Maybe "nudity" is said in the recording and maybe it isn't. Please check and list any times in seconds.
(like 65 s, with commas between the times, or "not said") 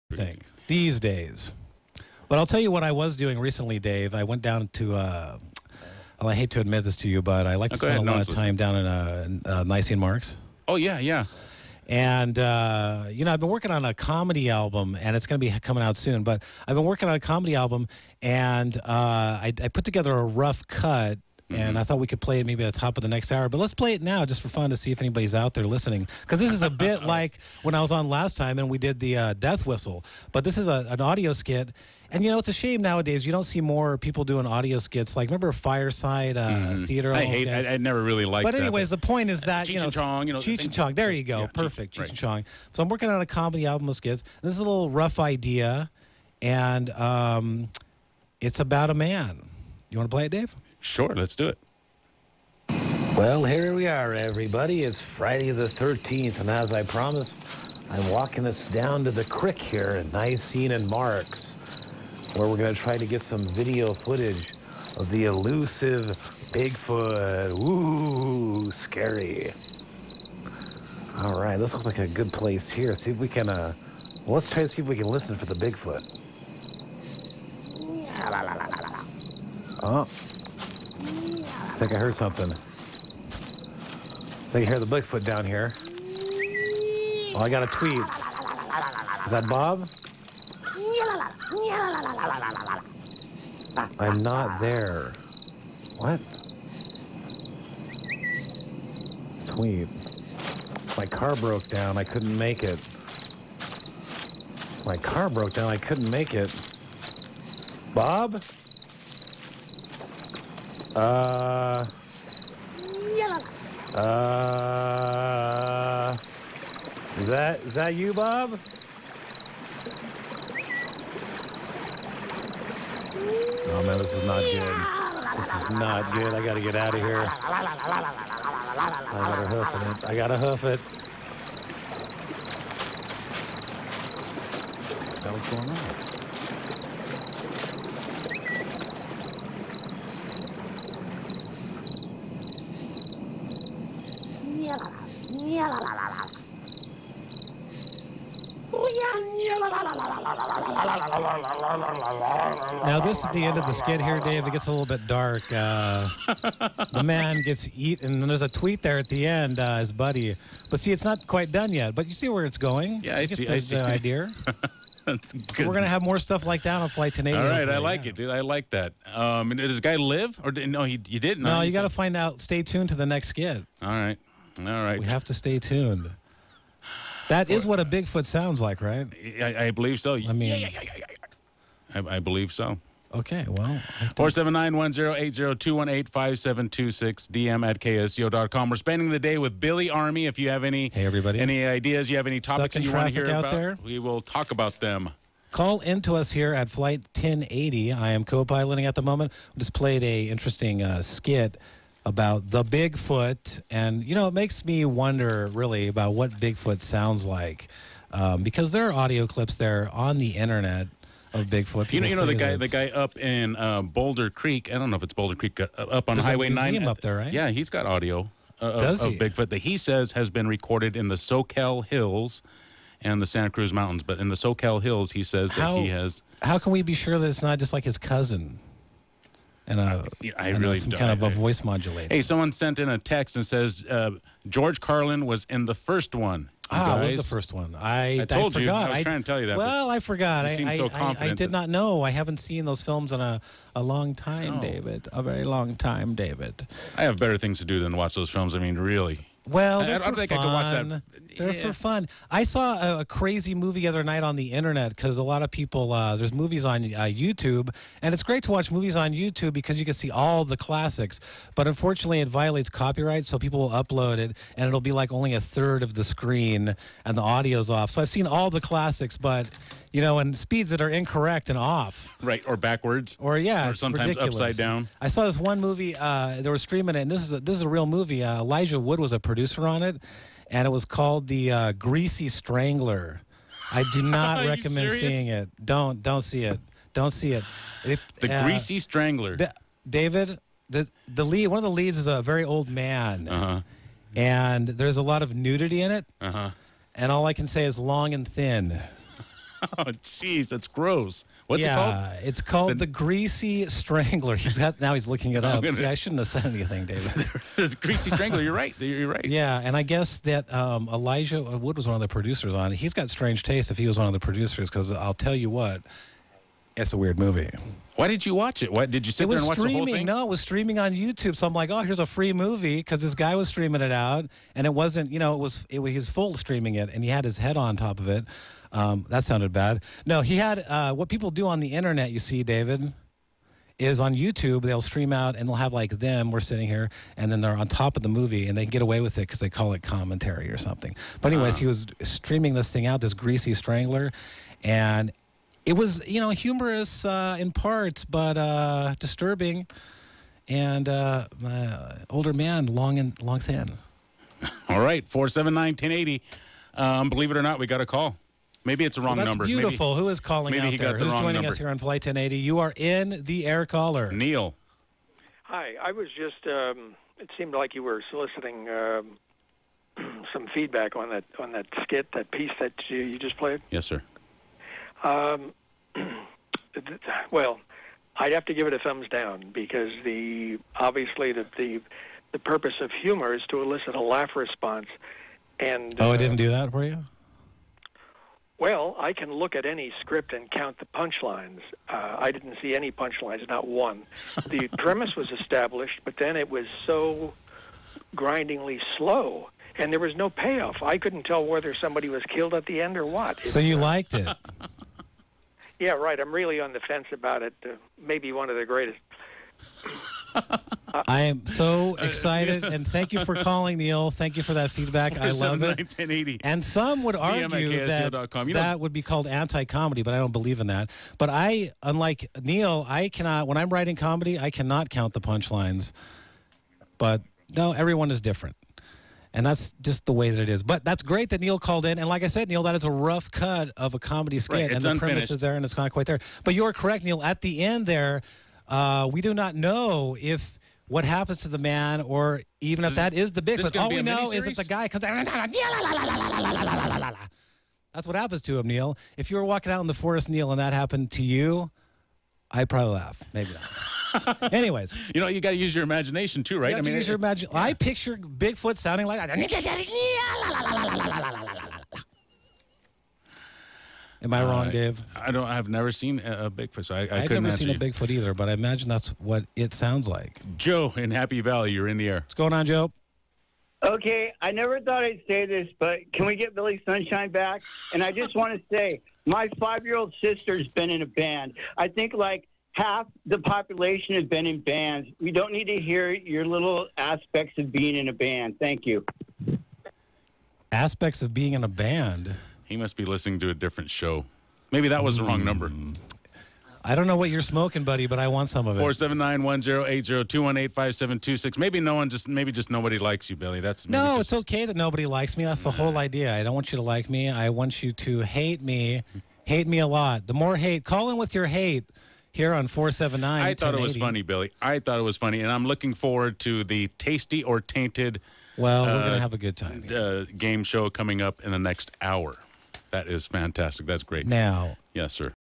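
295 s.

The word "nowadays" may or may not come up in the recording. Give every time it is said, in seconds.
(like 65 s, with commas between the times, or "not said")
32 s.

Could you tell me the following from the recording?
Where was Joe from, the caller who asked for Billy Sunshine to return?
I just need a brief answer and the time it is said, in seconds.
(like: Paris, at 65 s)
Happy Valley, at 471 s.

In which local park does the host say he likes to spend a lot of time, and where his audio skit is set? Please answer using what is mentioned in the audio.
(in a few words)
Nisene Marks.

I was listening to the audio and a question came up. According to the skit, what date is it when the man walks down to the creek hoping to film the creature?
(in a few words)
Friday the 13th.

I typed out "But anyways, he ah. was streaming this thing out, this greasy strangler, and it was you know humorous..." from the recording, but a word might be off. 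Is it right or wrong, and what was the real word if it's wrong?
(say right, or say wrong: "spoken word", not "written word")
right.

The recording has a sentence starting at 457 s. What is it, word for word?
I picture Bigfoot sounding like Am I wrong, uh, Dave?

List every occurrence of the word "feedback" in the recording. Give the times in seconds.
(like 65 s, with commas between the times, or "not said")
370 s, 414 s.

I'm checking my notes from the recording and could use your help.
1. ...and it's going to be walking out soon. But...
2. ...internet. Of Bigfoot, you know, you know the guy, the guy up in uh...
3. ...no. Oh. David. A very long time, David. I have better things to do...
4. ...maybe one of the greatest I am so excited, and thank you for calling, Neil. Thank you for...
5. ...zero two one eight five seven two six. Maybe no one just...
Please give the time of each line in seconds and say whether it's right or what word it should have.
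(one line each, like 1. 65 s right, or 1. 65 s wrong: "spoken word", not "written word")
1. 15 s wrong: "coming", not "walking"
2. 210 s right
3. 244 s right
4. 407 s right
5. 500 s right.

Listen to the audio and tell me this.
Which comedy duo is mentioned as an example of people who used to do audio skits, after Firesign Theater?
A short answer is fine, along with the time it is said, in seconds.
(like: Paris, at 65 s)
Cheech and Chong, at 40 s.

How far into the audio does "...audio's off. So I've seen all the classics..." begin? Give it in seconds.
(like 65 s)
267 s.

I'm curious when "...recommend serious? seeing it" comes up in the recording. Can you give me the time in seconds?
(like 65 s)
284 s.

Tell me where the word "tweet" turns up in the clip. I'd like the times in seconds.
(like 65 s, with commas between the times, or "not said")
87 s, 99 s, 158 s.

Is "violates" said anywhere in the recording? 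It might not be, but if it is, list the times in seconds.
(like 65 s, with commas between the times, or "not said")
262 s.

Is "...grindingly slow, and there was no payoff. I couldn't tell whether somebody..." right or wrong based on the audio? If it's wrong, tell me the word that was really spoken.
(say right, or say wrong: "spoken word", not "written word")
right.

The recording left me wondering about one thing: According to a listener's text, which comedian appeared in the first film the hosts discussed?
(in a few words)
George Carlin.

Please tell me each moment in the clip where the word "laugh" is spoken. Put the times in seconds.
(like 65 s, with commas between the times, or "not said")
384 s, 452 s.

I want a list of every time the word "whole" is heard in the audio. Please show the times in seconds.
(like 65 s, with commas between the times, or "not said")
319 s, 505 s.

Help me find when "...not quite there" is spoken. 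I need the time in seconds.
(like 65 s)
435 s.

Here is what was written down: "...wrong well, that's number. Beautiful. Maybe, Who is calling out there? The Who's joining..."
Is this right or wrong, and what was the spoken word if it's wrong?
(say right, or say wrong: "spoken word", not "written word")
right.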